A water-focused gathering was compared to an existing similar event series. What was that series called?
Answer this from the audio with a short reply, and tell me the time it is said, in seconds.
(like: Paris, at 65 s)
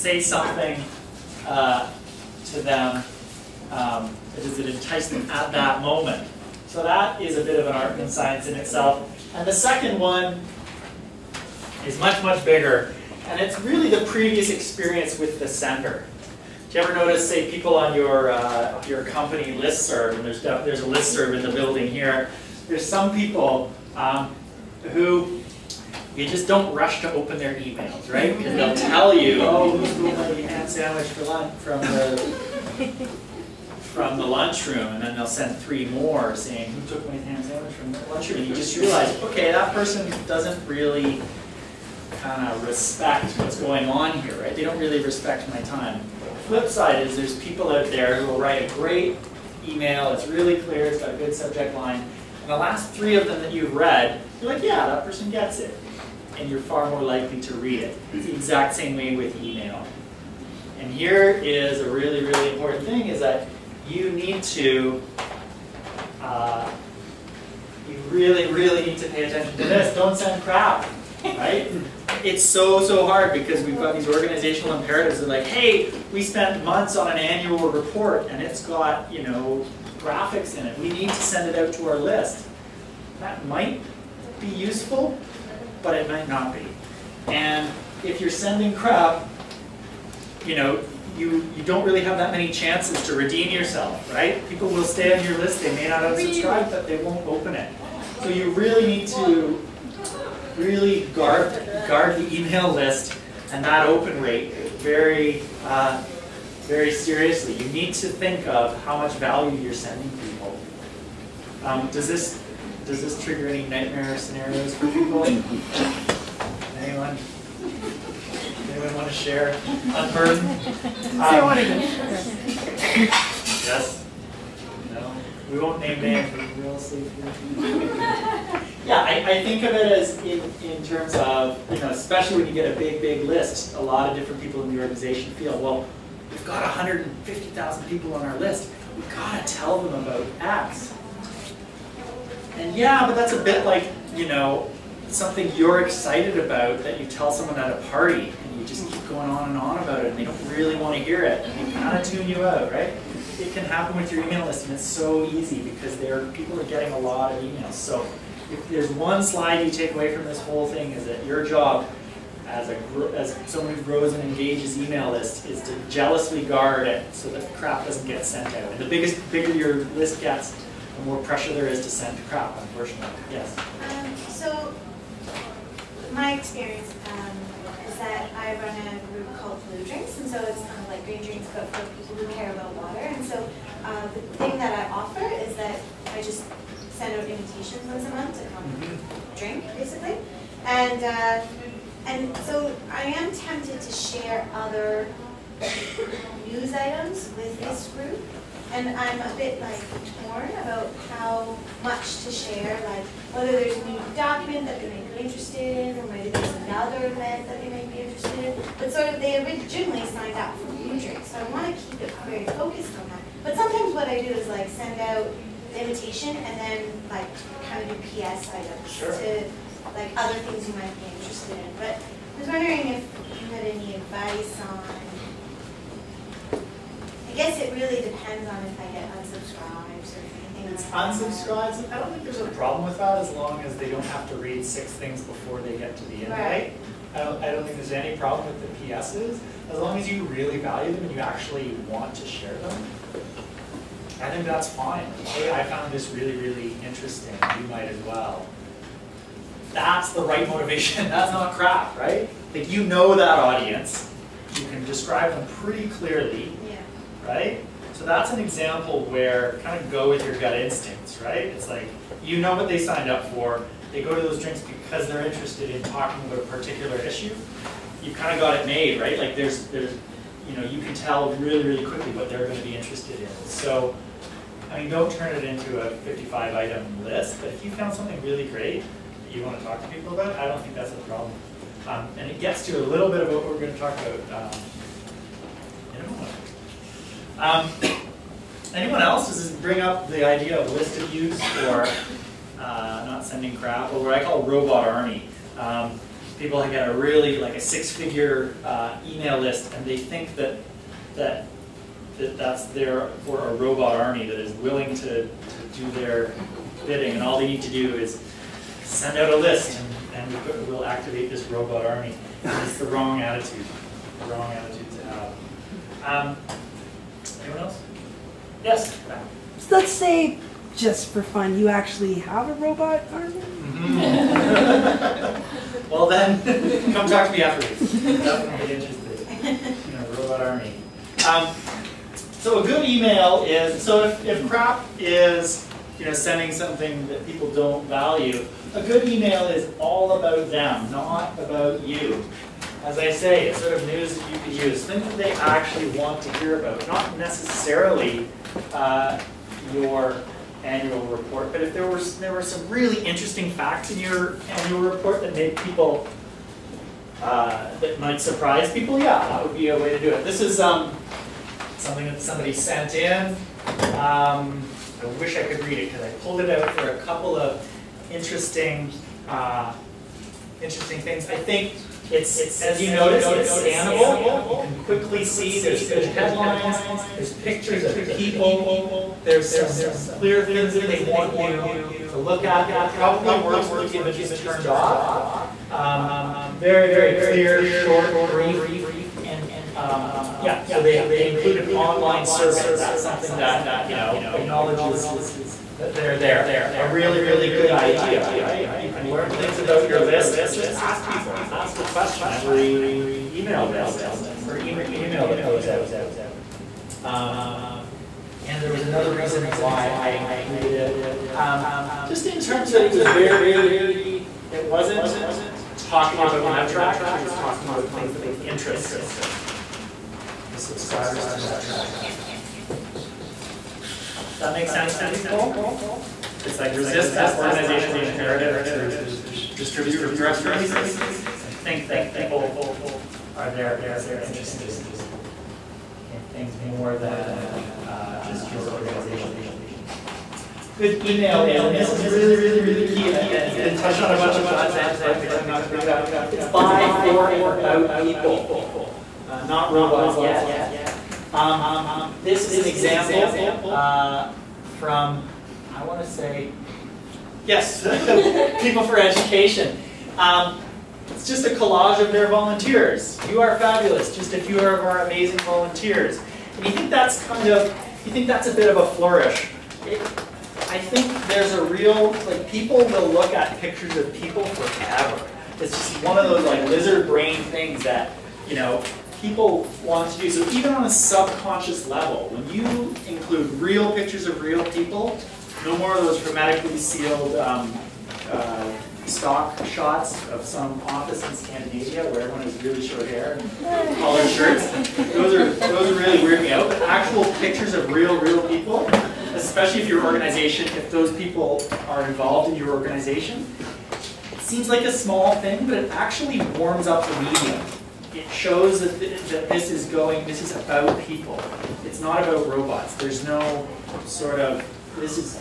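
Green Drinks, at 181 s.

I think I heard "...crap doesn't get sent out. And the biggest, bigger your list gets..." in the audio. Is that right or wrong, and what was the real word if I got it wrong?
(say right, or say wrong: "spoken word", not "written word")
right.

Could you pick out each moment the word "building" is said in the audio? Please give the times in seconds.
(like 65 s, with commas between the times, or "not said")
21 s.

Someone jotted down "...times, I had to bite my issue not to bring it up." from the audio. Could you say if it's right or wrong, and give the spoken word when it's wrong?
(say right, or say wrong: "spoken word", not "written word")
wrong: "tongue", not "issue".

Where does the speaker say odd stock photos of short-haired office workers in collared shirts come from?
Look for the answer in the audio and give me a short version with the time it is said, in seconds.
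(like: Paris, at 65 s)
Scandinavia, at 491 s.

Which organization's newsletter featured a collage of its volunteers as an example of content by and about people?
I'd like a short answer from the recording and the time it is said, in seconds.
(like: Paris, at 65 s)
People for Education, at 458 s.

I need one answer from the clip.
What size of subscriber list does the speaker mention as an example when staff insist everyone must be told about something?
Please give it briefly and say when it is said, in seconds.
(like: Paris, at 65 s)
150,000, at 136 s.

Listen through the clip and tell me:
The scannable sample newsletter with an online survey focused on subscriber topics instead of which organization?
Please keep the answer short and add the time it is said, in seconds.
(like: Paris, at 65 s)
METRAC, at 416 s.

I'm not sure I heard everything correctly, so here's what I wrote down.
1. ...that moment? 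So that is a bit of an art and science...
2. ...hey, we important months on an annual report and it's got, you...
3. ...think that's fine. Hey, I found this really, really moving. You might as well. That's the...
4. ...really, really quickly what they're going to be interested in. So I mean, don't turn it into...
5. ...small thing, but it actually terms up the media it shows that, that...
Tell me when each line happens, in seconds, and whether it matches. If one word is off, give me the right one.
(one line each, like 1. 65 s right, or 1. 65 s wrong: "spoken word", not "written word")
1. 5 s right
2. 75 s wrong: "spent", not "important"
3. 244 s wrong: "interesting", not "moving"
4. 271 s right
5. 504 s wrong: "warms", not "terms".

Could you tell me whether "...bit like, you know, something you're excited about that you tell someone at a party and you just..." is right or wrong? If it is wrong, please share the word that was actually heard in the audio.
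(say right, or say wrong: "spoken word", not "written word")
right.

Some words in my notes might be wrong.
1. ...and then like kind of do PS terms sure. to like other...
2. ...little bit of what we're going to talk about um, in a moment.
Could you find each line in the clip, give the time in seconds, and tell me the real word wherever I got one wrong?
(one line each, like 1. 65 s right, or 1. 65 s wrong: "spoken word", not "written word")
1. 216 s wrong: "items", not "terms"
2. 282 s right.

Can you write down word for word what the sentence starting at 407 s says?
Um, and there was another reason why I included it.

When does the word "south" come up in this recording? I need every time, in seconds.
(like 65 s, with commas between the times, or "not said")
not said.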